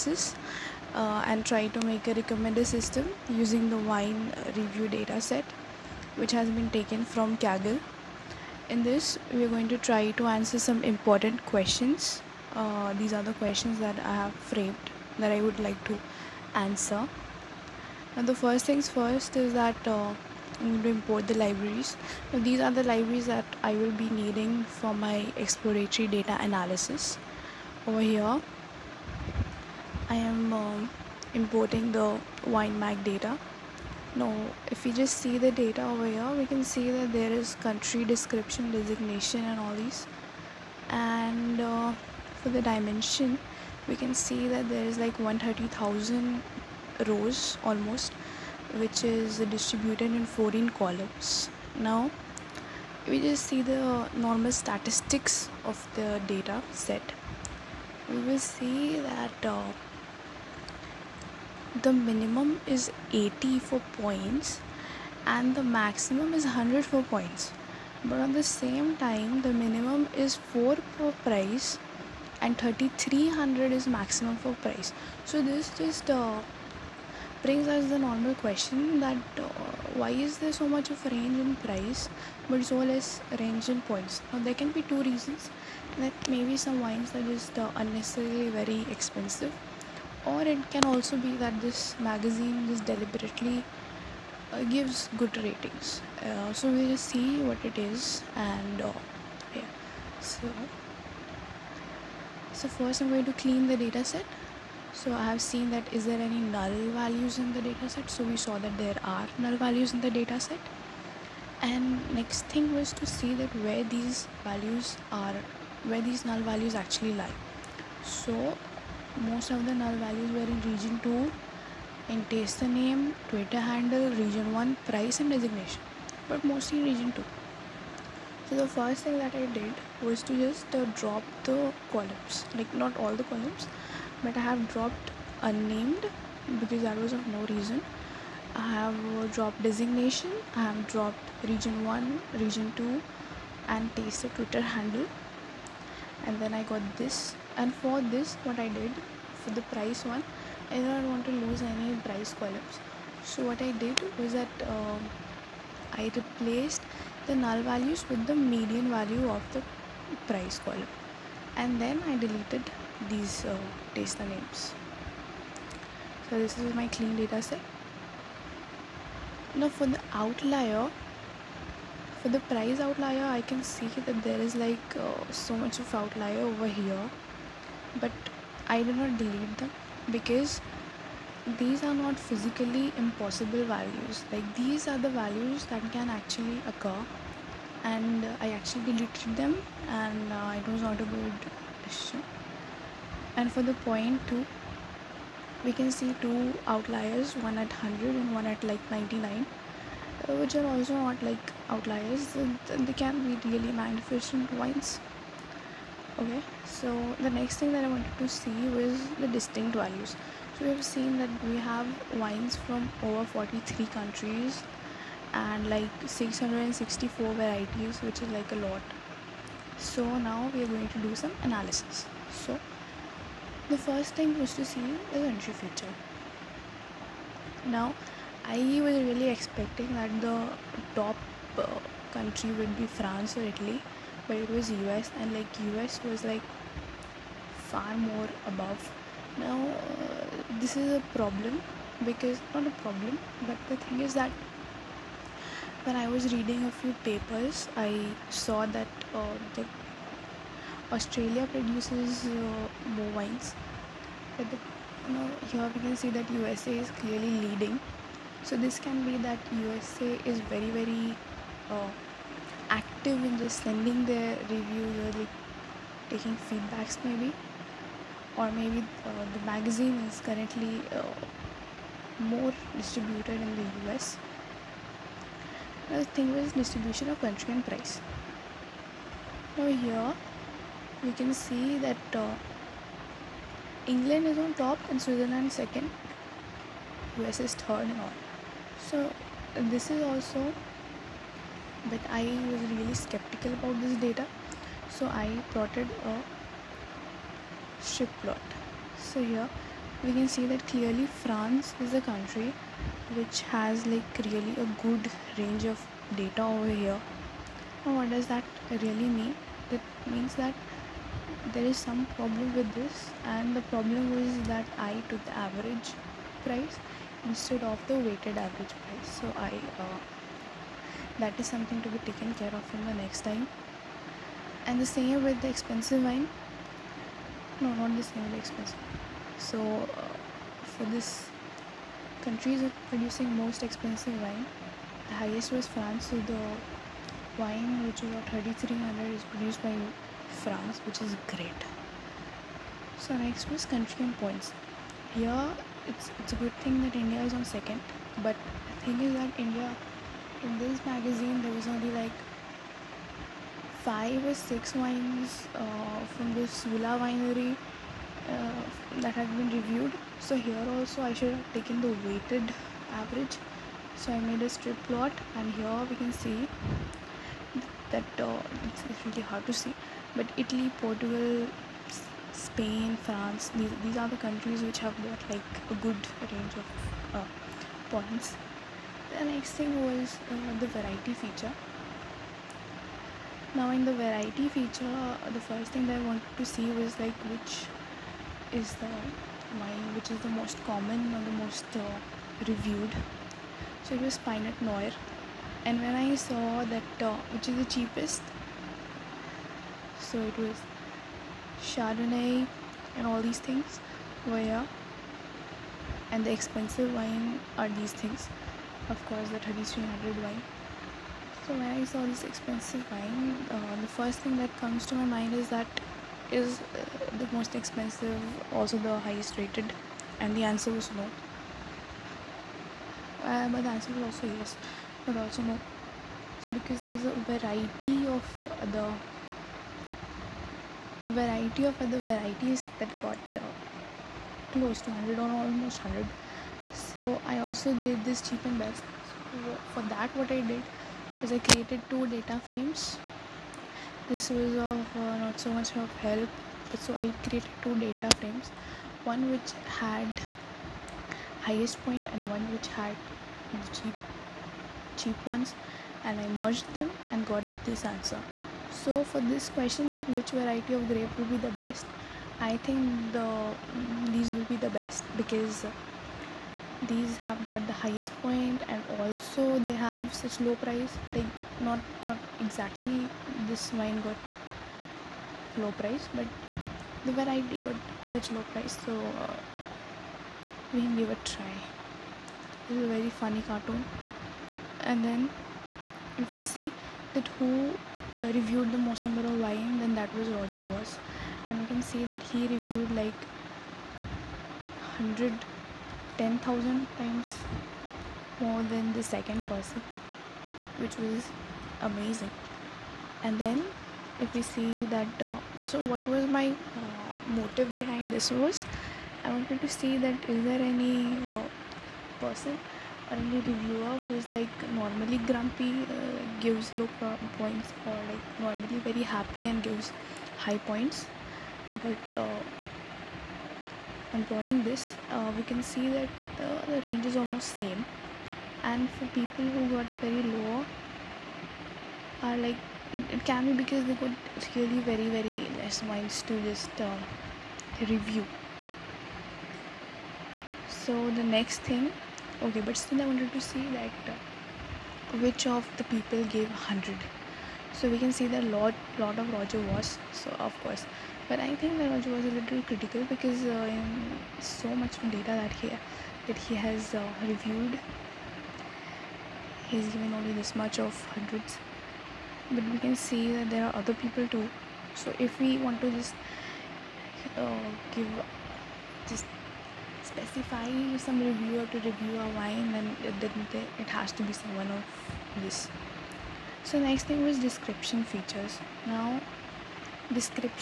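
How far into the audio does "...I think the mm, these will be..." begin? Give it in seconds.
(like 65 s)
462 s.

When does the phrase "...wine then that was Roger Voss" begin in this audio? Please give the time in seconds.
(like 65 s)
489 s.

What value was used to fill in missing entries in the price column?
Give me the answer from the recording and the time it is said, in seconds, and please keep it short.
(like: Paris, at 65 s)
Median, at 158 s.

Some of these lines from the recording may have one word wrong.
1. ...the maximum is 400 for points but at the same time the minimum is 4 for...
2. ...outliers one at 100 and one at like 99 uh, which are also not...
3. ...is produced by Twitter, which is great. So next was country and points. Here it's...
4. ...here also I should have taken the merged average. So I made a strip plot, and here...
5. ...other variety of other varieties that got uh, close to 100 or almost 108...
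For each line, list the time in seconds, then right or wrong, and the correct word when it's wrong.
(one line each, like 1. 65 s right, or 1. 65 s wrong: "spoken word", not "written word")
1. 65 s wrong: "100", not "400"
2. 196 s right
3. 339 s wrong: "France", not "Twitter"
4. 360 s wrong: "weighted", not "merged"
5. 428 s wrong: "100", not "108".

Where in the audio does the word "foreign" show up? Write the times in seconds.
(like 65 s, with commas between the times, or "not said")
not said.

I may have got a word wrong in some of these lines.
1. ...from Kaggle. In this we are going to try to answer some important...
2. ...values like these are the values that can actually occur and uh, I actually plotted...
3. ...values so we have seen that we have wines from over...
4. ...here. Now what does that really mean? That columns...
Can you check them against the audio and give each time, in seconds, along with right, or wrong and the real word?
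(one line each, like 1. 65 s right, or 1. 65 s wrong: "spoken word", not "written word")
1. 7 s right
2. 183 s wrong: "deleted", not "plotted"
3. 209 s right
4. 306 s wrong: "means", not "columns".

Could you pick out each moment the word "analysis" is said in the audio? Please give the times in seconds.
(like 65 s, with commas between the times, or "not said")
26 s, 221 s.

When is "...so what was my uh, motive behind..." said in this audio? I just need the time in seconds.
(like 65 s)
505 s.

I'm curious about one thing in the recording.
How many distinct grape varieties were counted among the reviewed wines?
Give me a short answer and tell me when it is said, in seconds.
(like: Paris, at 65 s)
664, at 216 s.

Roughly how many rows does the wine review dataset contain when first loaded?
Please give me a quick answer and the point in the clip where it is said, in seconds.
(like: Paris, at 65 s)
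130,000, at 45 s.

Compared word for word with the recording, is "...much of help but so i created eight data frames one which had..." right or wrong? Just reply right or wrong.
wrong.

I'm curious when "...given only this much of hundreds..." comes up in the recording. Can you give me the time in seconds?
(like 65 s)
559 s.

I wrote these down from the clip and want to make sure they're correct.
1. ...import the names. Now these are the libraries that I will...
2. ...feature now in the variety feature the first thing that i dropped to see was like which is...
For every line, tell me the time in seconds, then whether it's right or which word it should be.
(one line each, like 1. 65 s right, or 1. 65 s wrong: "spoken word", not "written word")
1. 20 s wrong: "libraries", not "names"
2. 381 s wrong: "wanted", not "dropped".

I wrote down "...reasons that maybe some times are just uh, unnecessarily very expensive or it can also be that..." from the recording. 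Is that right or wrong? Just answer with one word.
wrong.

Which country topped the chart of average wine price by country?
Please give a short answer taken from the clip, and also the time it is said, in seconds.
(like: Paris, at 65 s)
England, at 283 s.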